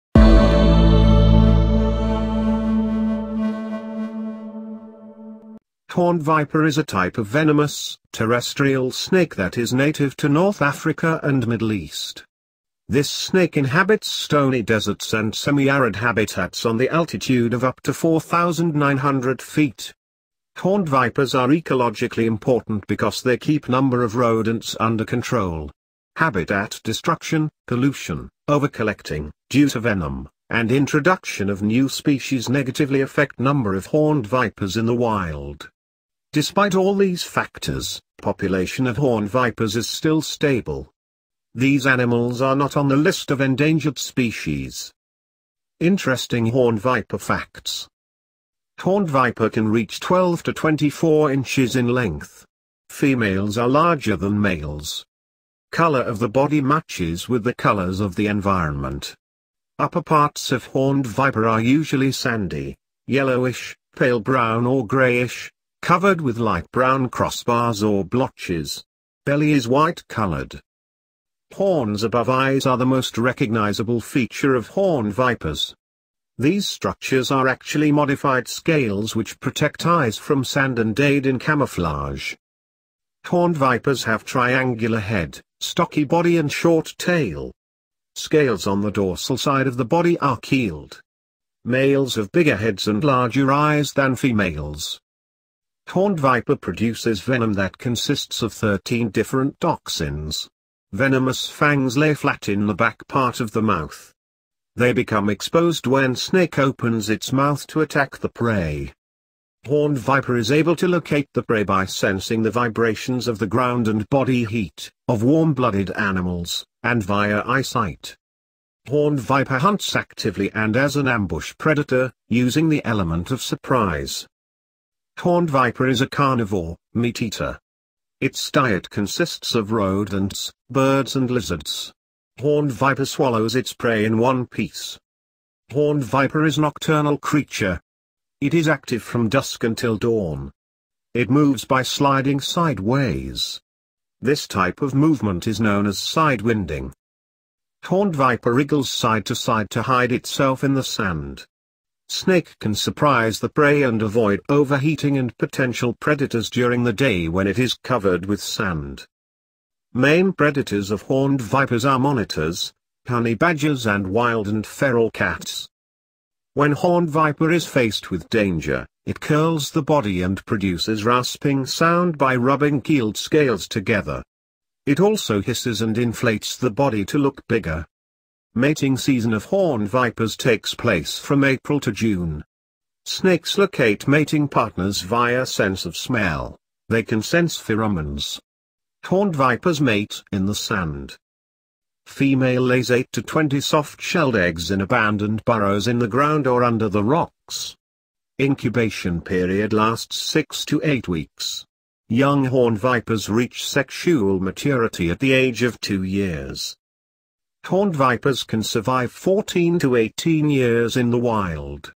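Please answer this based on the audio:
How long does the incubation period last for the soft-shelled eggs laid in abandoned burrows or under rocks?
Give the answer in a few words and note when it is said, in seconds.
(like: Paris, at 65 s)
6 to 8 weeks, at 200 s.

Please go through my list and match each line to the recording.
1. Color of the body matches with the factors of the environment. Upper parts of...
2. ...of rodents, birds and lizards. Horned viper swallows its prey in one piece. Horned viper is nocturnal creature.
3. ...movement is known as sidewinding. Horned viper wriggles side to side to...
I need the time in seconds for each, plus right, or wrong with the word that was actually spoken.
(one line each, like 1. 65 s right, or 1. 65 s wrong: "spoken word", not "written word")
1. 55 s wrong: "colors", not "factors"
2. 129 s right
3. 144 s right.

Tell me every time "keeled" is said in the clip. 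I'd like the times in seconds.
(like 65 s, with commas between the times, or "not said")
90 s, 172 s.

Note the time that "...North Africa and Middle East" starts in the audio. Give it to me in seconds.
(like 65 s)
10 s.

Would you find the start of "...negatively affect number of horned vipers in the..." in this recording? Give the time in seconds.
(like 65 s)
32 s.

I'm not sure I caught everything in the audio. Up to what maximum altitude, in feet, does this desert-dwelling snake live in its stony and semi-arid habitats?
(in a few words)
4,900 feet.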